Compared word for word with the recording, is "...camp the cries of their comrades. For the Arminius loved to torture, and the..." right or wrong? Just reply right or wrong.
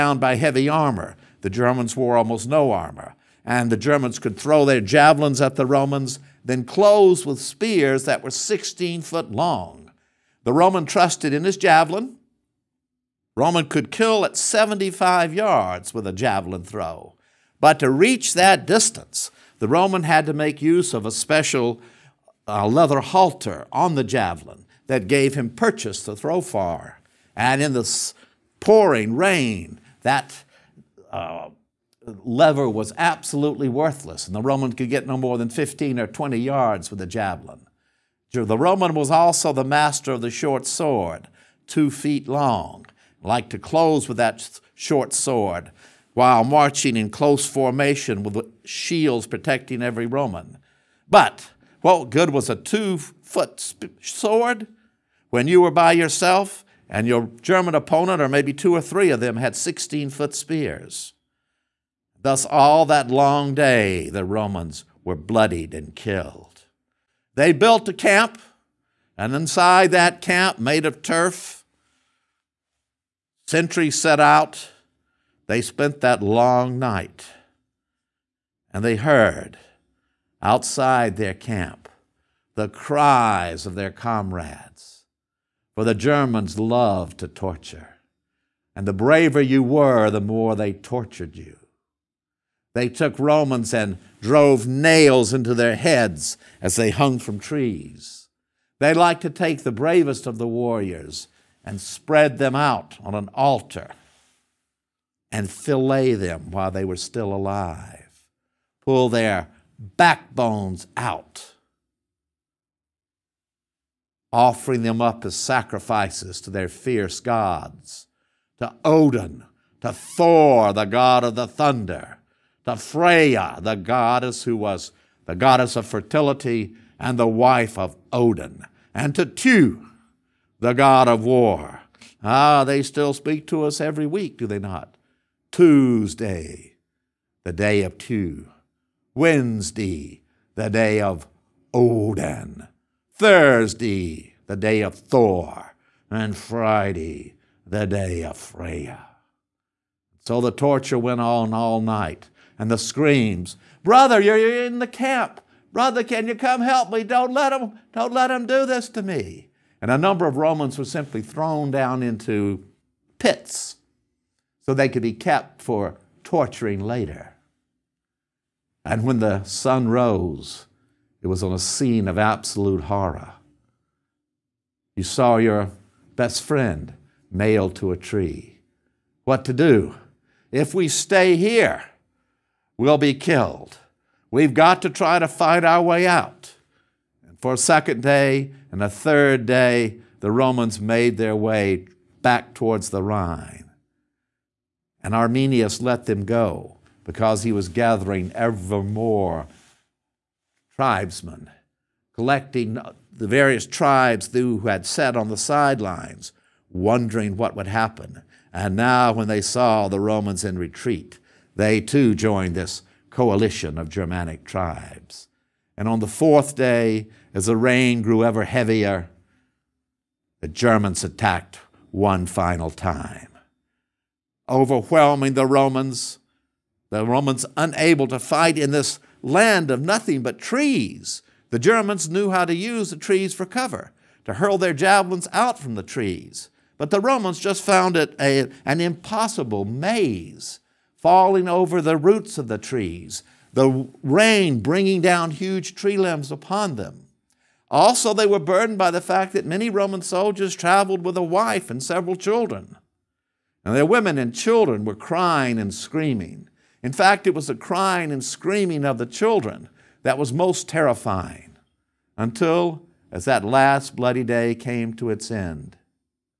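wrong.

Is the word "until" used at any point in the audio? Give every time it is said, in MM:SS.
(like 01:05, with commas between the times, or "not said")
04:22.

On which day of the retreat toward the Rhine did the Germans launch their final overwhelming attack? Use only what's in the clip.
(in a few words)
4th day.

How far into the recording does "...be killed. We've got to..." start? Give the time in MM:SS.
03:02.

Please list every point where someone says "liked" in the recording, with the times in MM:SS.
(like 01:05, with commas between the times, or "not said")
00:43, 01:38.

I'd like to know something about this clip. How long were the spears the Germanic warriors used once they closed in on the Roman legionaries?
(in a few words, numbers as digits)
16 feet.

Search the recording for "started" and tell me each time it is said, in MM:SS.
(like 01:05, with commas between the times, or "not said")
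not said.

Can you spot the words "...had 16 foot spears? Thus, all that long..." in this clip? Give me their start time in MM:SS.
00:59.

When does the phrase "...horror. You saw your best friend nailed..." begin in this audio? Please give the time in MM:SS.
02:52.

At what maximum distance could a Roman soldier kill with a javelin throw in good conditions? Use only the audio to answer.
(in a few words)
75 yards.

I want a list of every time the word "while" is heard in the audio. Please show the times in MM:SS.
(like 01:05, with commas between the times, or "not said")
00:46, 01:46.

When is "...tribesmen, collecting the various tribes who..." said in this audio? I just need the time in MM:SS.
03:20.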